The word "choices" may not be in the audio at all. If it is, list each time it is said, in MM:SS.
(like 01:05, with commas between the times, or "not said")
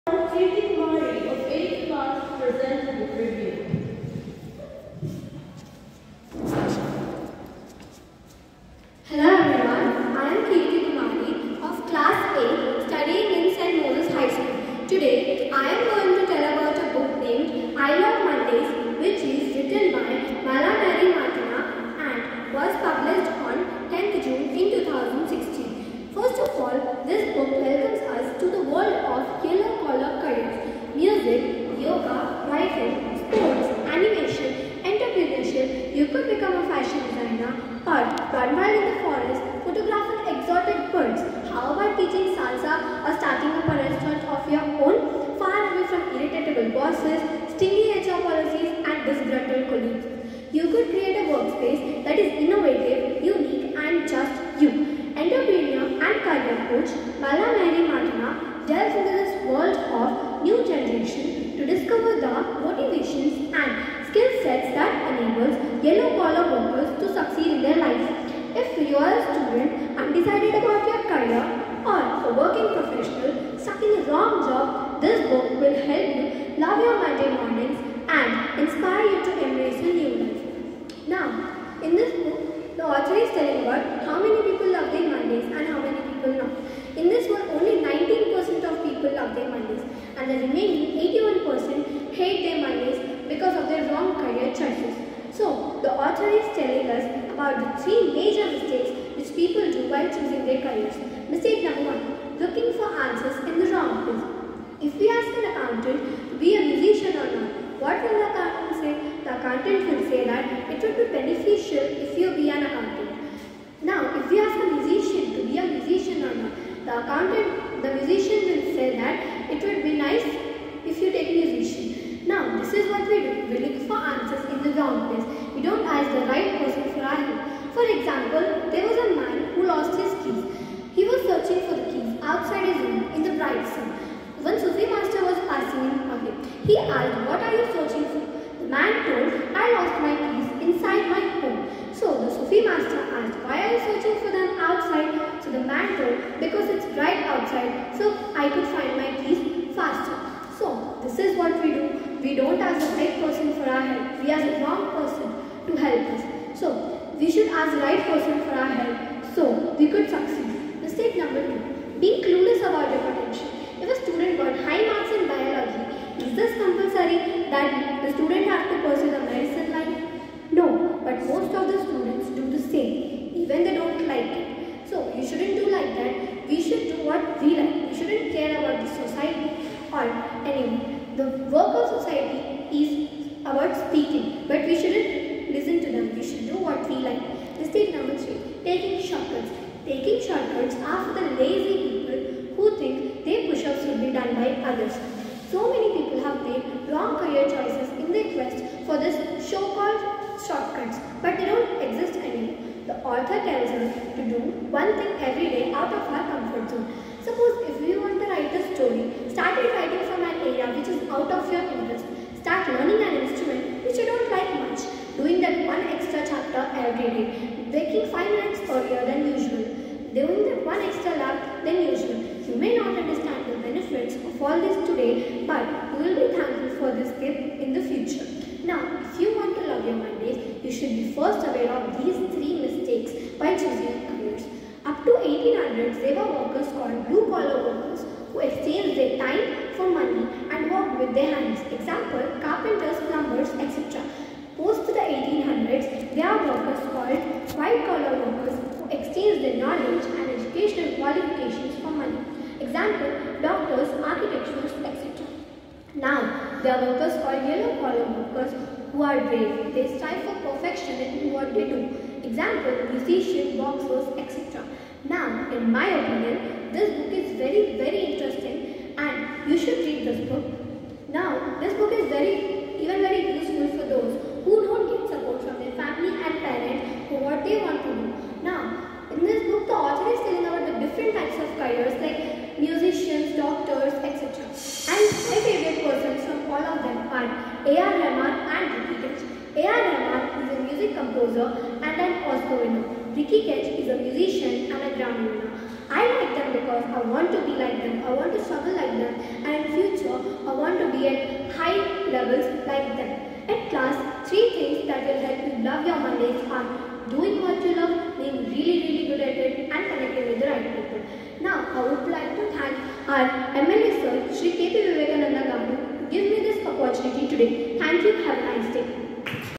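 01:34, 03:17.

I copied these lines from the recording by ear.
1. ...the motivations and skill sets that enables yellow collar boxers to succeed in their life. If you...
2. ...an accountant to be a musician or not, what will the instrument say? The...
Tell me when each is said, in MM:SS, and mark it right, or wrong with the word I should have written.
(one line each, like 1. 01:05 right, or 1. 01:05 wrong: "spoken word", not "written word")
1. 01:02 wrong: "workers", not "boxers"
2. 01:45 wrong: "accountant", not "instrument".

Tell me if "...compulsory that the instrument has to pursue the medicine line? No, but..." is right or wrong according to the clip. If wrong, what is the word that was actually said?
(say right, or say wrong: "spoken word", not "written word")
wrong: "student", not "instrument".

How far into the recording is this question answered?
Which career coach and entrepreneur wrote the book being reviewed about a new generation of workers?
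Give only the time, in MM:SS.
00:57.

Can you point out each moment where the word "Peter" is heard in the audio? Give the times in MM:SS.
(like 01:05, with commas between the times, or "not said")
not said.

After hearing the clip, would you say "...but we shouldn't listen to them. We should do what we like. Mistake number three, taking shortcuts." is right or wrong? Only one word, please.
right.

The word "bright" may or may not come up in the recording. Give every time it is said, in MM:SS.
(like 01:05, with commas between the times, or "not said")
02:13, 02:26.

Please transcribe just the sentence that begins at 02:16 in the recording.
He asked, what are you searching for?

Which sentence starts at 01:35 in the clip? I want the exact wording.
So, the author is telling us about the three major mistakes which people do while choosing their careers.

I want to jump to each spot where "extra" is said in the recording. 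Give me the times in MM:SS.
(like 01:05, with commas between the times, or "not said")
03:35, 03:40.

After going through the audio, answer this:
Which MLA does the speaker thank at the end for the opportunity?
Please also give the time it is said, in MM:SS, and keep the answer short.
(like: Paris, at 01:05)
Sri K.P. Vivekananda Gandhi, at 05:14.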